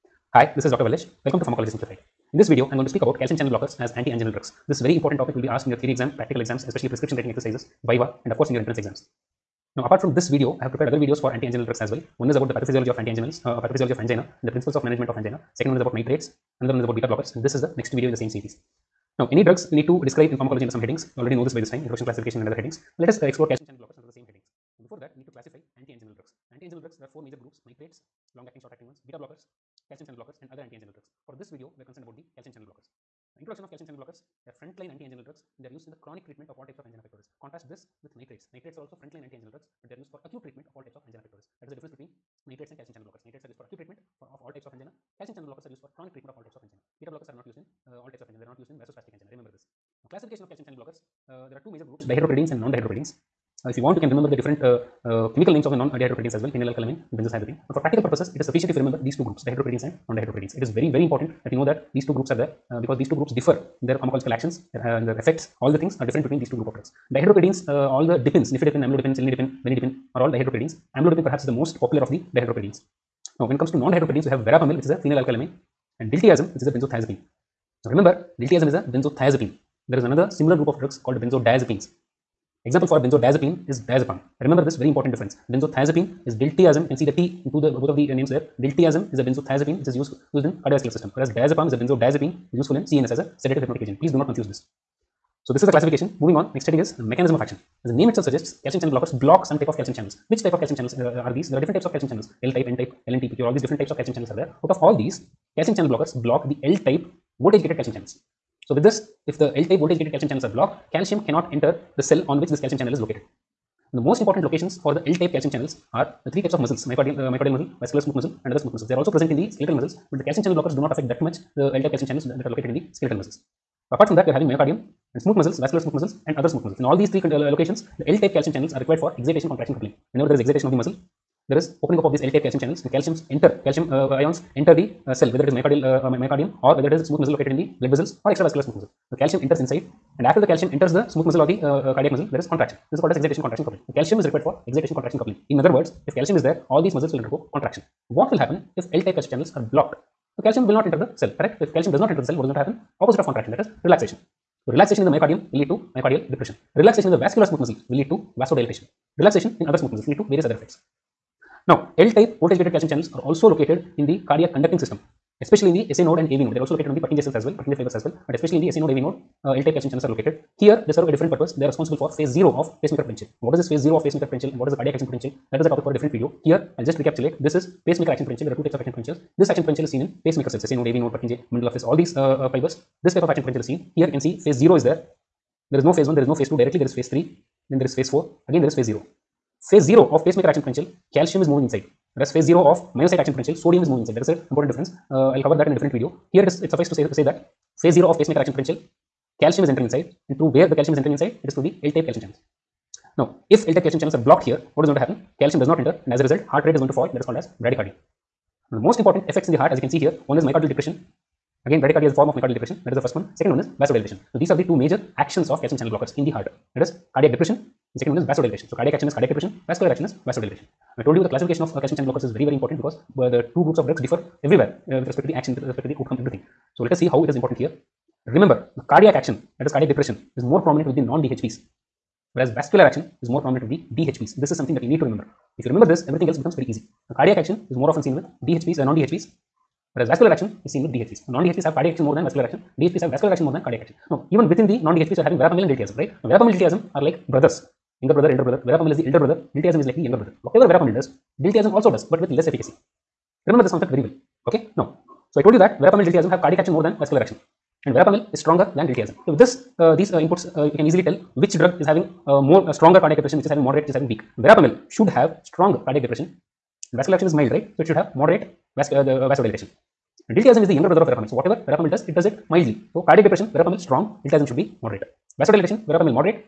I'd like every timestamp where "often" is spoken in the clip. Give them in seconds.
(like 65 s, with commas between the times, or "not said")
237 s.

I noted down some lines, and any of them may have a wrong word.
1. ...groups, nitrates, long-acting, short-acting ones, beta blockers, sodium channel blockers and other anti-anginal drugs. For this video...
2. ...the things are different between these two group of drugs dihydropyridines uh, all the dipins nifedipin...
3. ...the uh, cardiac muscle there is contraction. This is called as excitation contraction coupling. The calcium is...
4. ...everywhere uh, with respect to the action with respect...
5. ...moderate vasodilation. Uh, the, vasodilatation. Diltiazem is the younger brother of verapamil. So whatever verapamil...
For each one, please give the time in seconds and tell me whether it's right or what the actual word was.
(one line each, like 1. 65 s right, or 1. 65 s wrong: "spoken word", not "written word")
1. 27 s wrong: "calcium", not "sodium"
2. 65 s right
3. 141 s right
4. 224 s right
5. 268 s right.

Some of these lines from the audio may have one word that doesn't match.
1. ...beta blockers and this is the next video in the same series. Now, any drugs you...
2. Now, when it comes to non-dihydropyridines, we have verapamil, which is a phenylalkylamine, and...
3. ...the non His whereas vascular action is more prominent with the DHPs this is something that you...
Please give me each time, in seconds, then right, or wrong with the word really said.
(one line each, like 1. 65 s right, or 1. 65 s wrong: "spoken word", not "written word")
1. 16 s right
2. 73 s right
3. 230 s wrong: "DHPs", not "His".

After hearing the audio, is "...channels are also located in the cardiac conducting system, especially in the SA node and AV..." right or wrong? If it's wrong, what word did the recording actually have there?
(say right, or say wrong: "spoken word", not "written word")
right.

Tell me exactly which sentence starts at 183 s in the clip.
This type of action potential is seen.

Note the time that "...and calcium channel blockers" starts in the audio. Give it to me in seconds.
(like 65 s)
42 s.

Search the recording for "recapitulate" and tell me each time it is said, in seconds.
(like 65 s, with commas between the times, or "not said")
177 s.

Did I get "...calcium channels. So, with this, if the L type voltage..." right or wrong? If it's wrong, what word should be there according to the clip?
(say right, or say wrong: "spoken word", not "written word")
right.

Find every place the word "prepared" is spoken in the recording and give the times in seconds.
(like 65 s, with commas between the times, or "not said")
10 s.